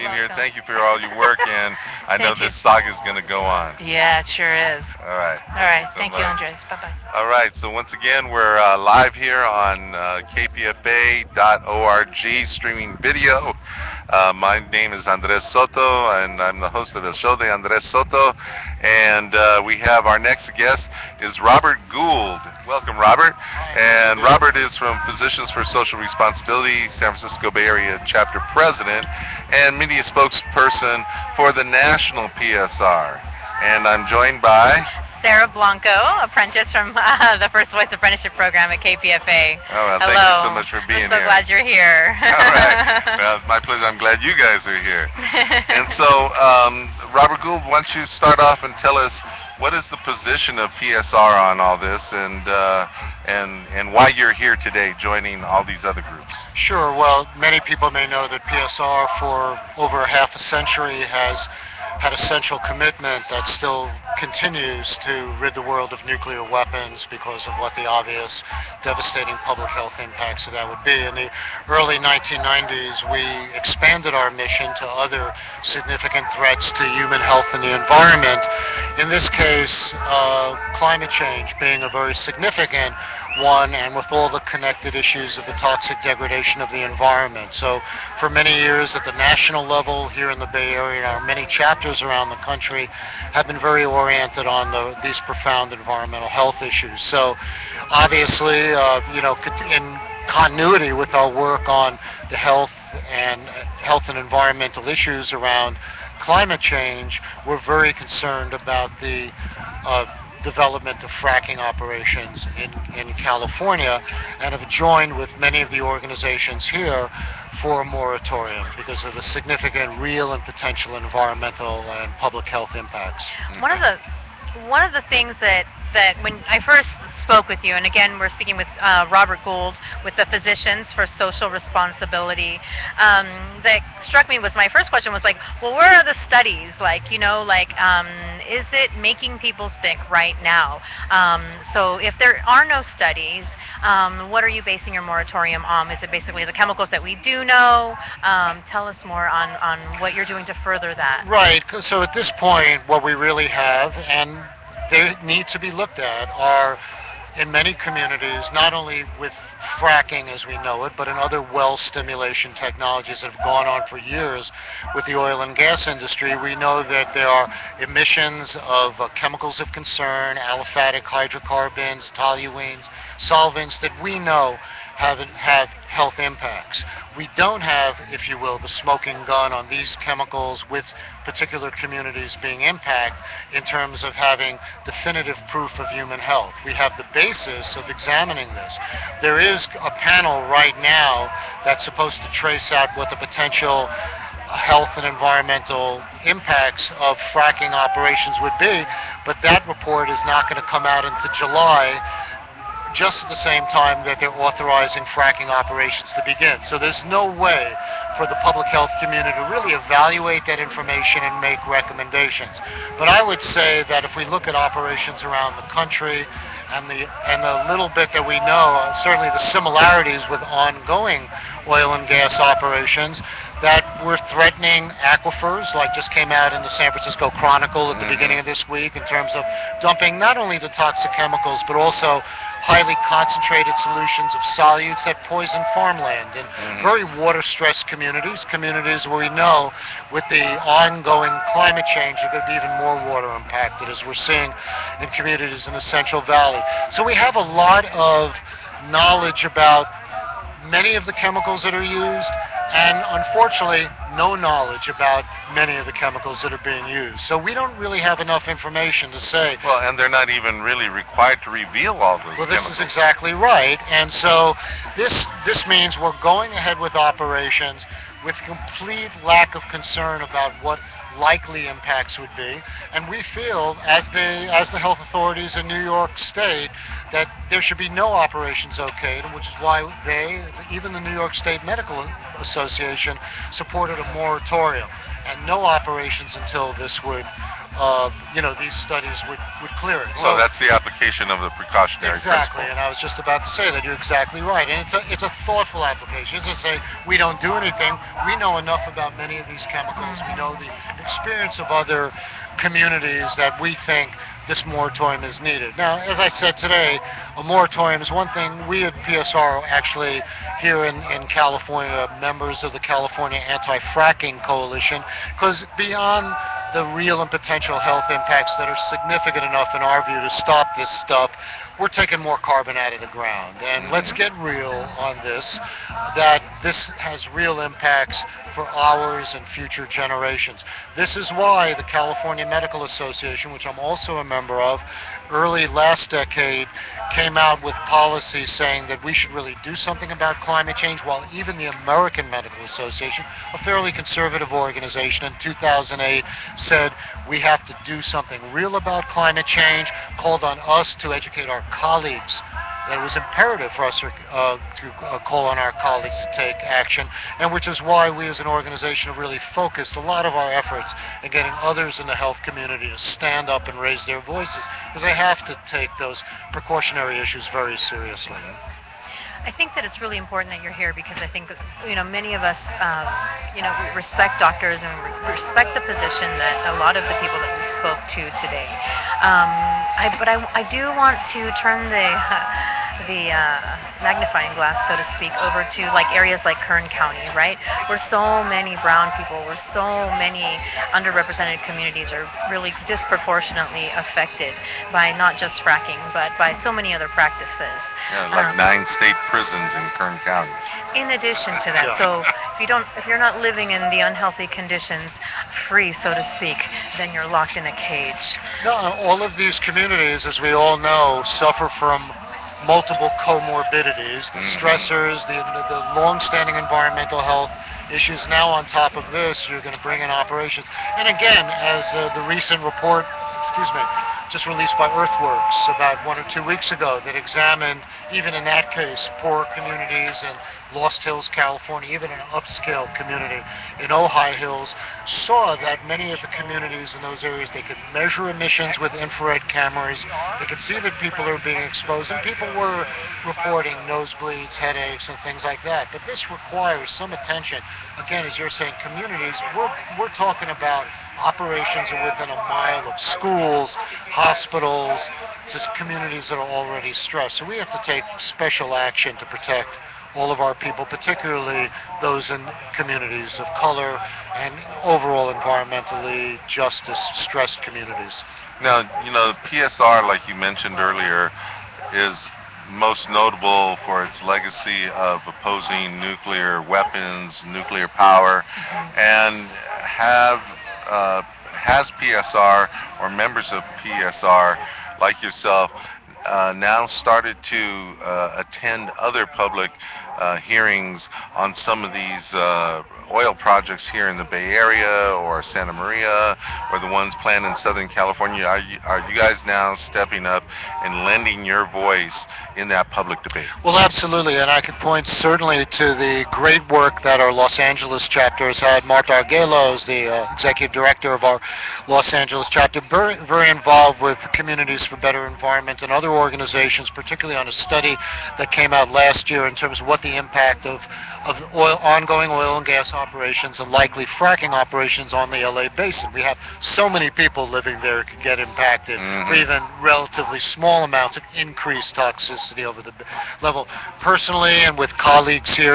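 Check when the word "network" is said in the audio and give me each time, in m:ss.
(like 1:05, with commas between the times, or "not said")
not said.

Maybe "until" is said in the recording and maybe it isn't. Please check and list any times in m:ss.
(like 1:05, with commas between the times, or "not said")
3:21, 4:46.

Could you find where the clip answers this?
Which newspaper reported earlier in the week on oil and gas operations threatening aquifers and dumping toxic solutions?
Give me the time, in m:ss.
3:46.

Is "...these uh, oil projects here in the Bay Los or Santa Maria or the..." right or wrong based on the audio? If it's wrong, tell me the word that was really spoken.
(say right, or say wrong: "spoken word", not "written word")
wrong: "Area", not "Los".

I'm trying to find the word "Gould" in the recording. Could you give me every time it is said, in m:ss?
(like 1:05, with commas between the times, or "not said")
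0:21, 0:47, 2:09.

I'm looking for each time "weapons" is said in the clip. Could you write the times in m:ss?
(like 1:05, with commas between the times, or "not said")
1:06, 7:56.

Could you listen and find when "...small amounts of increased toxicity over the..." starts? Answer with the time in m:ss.
8:50.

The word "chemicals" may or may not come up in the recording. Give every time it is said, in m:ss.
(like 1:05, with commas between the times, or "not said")
2:26, 2:49, 2:59, 3:51, 4:11, 4:15, 4:22, 4:59.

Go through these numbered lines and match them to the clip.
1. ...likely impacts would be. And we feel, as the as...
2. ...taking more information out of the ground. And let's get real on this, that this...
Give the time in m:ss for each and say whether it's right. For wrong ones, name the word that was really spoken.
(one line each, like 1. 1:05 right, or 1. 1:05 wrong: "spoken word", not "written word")
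1. 4:31 right
2. 5:21 wrong: "carbon", not "information".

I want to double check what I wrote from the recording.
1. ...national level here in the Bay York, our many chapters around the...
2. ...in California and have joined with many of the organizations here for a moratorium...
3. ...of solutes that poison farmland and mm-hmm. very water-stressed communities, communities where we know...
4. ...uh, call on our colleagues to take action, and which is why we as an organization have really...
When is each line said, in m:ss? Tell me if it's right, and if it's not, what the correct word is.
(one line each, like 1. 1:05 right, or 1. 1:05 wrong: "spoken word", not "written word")
1. 1:29 wrong: "Area", not "York"
2. 1:53 right
3. 3:54 right
4. 5:55 right.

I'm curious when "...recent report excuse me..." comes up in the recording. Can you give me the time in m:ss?
7:02.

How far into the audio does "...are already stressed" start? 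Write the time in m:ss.
7:36.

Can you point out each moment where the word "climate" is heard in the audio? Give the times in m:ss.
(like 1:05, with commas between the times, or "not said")
1:20, 1:46, 4:01, 5:40, 5:49.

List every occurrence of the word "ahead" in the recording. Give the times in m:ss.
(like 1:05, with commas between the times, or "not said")
4:26.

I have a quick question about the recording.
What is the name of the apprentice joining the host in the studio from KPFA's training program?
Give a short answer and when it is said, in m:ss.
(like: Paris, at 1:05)
Sara Blanco, at 0:35.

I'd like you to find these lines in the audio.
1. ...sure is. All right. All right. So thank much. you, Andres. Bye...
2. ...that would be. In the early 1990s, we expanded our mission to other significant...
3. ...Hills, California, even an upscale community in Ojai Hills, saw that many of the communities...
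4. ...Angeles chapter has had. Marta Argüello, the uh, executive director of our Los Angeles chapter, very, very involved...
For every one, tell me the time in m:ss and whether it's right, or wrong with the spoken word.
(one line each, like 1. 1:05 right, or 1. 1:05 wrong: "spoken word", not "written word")
1. 0:04 right
2. 1:10 right
3. 7:11 right
4. 8:27 right.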